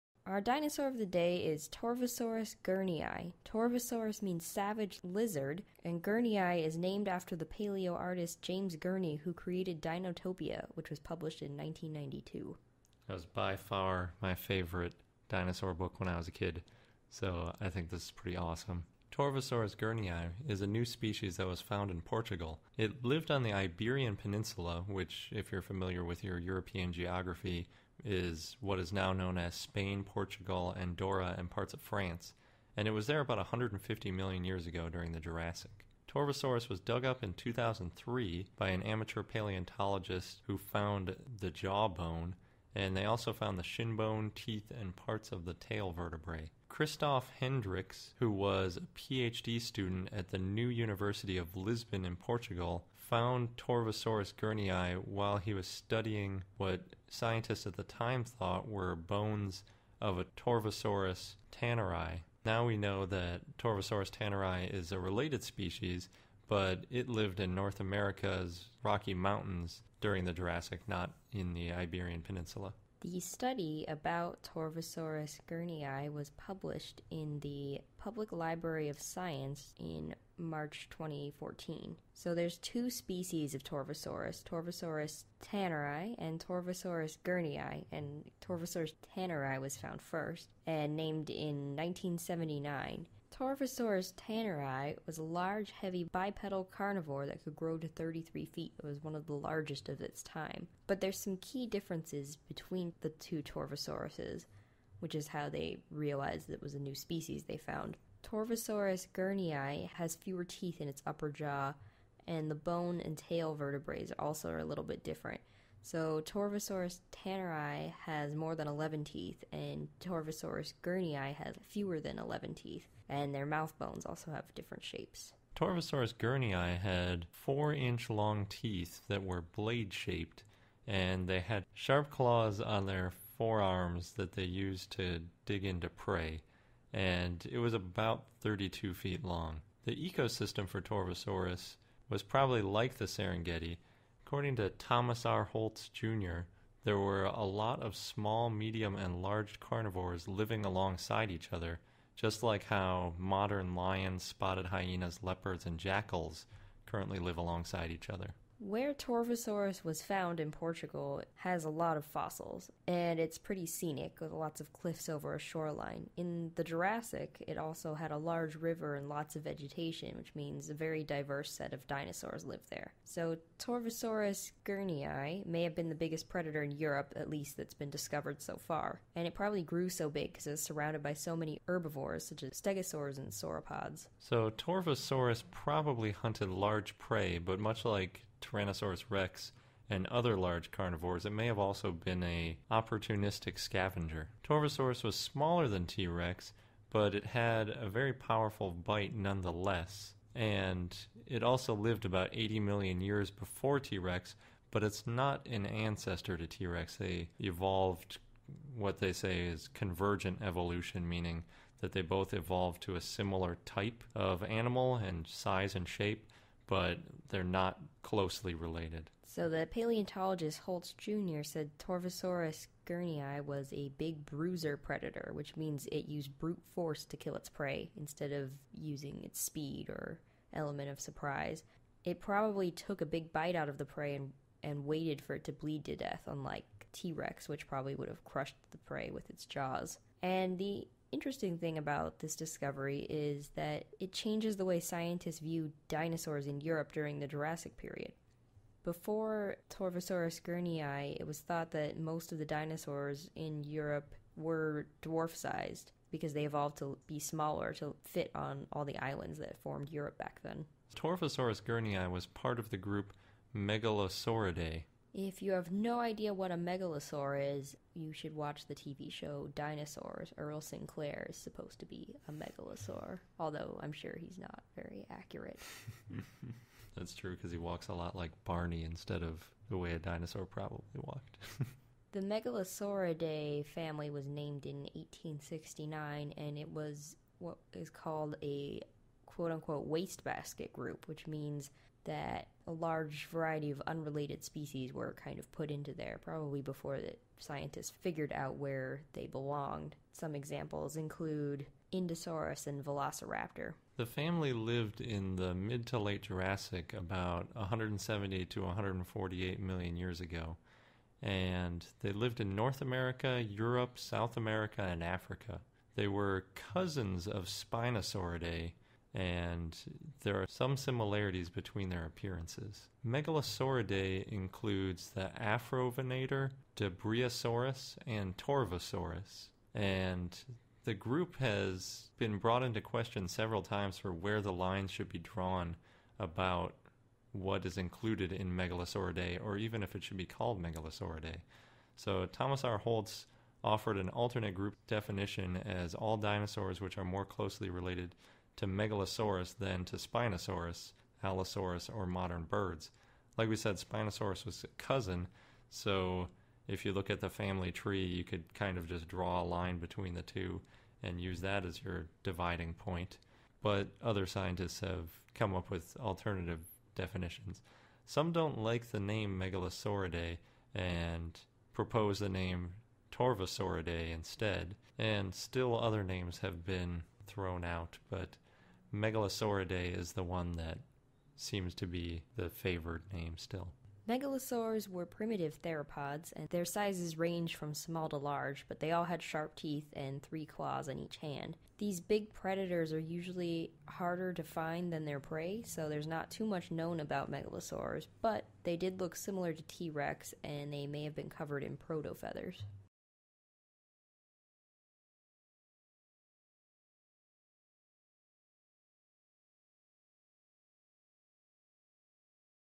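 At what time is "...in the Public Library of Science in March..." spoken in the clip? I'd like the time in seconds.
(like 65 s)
77 s.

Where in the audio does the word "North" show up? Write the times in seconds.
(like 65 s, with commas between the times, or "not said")
67 s, 312 s.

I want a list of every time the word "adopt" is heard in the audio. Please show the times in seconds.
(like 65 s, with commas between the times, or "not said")
not said.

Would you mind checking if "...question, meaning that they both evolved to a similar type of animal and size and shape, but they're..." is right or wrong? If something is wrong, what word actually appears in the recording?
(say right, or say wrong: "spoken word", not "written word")
wrong: "evolution", not "question".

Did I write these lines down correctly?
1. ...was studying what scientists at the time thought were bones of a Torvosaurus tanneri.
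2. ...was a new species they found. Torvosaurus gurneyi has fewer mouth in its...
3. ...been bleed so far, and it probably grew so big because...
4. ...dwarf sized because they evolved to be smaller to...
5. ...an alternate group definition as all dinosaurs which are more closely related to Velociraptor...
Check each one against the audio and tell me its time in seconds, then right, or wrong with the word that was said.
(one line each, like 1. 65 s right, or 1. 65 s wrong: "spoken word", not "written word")
1. 55 s right
2. 106 s wrong: "teeth", not "mouth"
3. 177 s wrong: "discovered", not "bleed"
4. 255 s right
5. 343 s wrong: "Megalosaurus", not "Velociraptor".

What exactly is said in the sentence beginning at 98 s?
It was one of the largest of its time.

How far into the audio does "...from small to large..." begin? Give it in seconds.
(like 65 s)
387 s.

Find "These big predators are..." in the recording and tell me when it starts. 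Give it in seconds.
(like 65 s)
391 s.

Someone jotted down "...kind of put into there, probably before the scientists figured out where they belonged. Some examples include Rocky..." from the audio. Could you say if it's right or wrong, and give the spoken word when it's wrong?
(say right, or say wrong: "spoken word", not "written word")
wrong: "Indosaurus", not "Rocky".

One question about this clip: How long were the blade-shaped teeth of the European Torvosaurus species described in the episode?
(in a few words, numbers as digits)
4 inches.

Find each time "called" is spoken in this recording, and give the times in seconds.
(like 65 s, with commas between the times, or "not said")
287 s, 340 s.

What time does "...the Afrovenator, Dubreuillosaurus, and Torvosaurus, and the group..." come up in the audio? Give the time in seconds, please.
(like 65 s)
325 s.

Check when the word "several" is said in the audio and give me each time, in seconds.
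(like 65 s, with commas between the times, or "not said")
333 s.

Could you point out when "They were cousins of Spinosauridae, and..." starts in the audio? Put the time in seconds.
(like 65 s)
315 s.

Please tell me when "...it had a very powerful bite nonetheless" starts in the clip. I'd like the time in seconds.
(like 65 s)
197 s.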